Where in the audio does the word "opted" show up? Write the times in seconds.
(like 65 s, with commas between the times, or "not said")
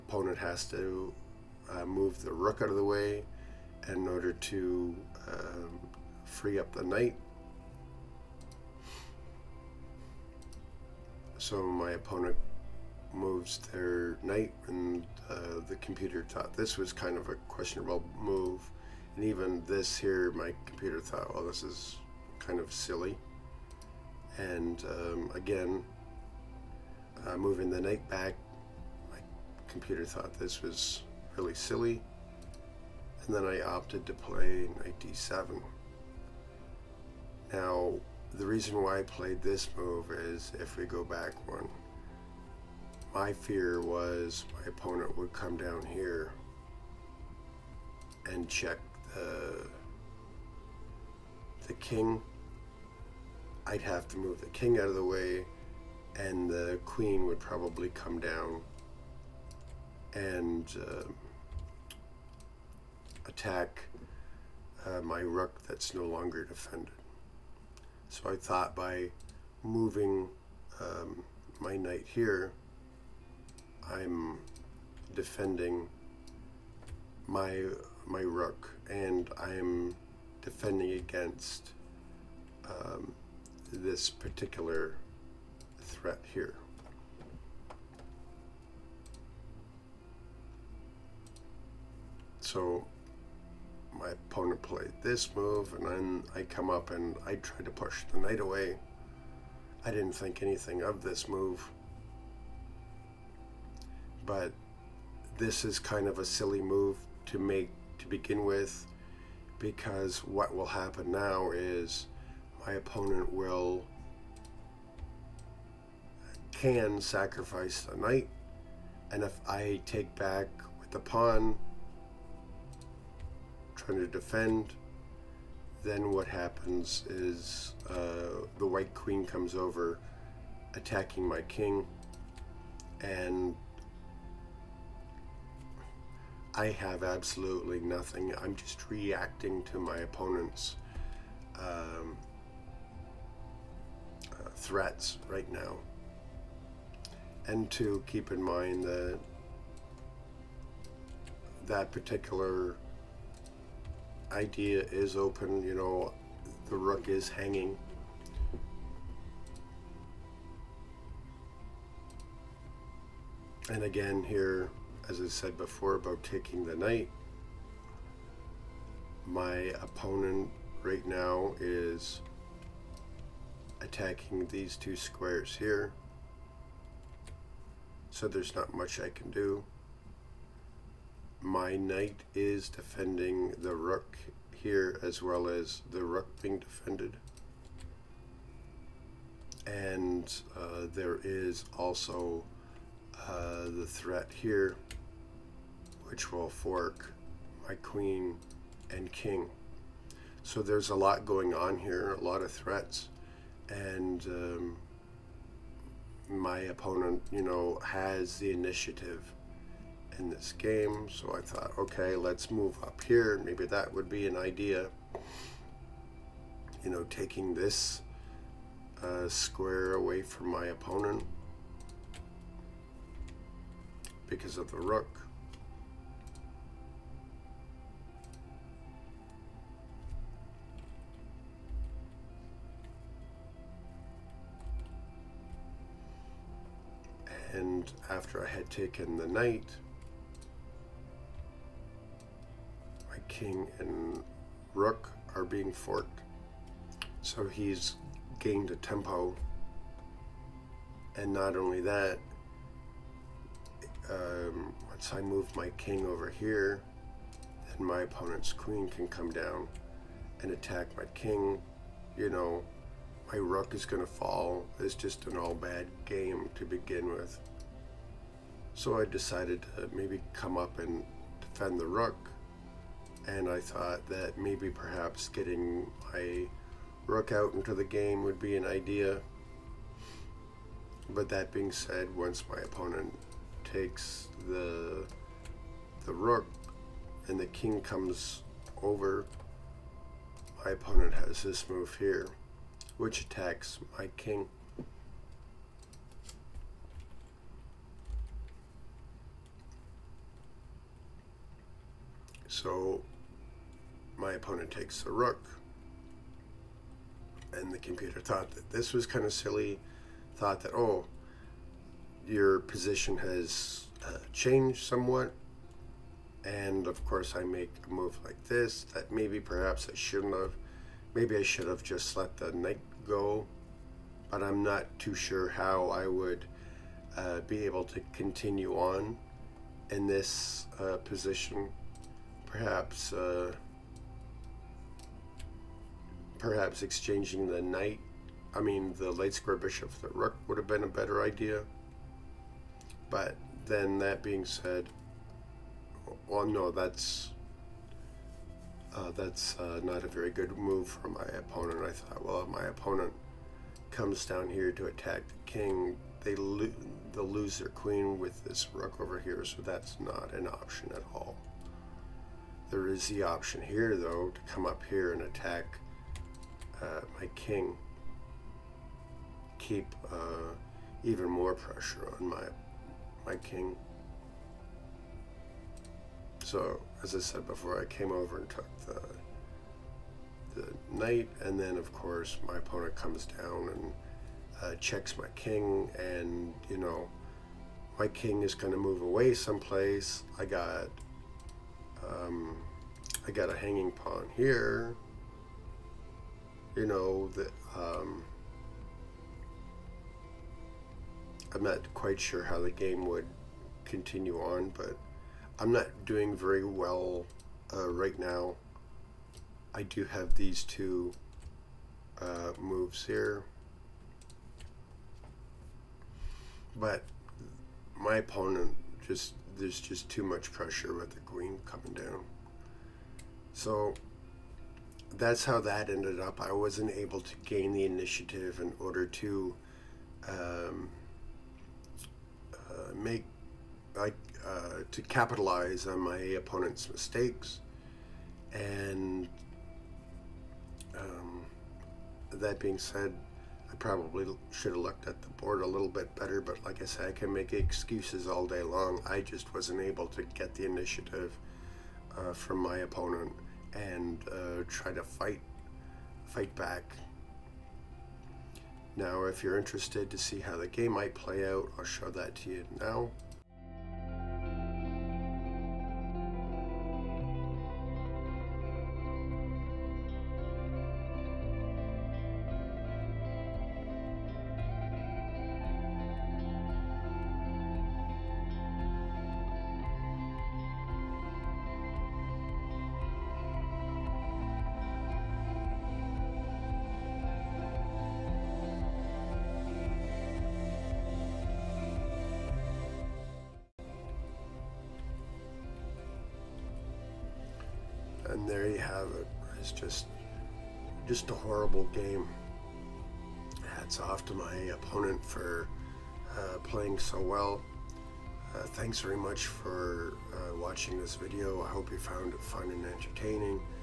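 33 s.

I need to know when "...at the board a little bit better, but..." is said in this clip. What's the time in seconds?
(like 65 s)
445 s.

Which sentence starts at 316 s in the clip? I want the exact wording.
And of course, I make a move like this that maybe perhaps I shouldn't have.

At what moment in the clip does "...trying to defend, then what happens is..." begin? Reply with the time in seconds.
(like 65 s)
123 s.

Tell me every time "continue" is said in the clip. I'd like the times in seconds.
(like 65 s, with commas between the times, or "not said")
328 s, 403 s.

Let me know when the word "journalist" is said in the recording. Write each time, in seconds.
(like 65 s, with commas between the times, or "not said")
not said.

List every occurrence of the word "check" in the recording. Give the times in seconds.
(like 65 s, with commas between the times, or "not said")
48 s, 384 s.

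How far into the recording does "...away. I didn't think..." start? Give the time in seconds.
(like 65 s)
98 s.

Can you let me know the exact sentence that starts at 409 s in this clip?
I do have these two uh, moves here.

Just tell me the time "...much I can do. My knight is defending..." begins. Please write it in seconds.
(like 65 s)
178 s.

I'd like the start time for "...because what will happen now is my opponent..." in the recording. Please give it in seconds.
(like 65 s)
109 s.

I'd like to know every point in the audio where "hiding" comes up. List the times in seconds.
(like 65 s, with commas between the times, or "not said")
not said.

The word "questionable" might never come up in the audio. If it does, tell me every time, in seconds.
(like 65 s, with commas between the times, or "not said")
17 s.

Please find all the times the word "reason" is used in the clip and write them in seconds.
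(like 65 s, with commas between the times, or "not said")
38 s.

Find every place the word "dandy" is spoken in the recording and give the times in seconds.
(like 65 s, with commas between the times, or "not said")
not said.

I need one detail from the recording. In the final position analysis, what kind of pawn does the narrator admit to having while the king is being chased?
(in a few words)
Hanging pawn.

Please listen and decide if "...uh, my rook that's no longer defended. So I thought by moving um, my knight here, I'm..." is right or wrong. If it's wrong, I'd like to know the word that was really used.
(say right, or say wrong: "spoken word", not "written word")
right.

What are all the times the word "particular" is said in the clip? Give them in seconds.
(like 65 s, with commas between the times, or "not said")
84 s, 151 s.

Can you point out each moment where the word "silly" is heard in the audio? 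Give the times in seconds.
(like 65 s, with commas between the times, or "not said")
22 s, 31 s, 106 s, 309 s.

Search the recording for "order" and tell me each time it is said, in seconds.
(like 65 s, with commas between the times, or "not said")
4 s, 428 s.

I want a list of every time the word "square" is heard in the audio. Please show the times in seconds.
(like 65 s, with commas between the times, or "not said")
174 s, 219 s, 339 s.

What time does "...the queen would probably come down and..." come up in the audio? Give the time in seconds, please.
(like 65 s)
56 s.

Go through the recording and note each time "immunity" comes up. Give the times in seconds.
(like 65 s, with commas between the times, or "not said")
not said.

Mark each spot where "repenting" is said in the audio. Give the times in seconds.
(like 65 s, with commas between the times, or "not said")
not said.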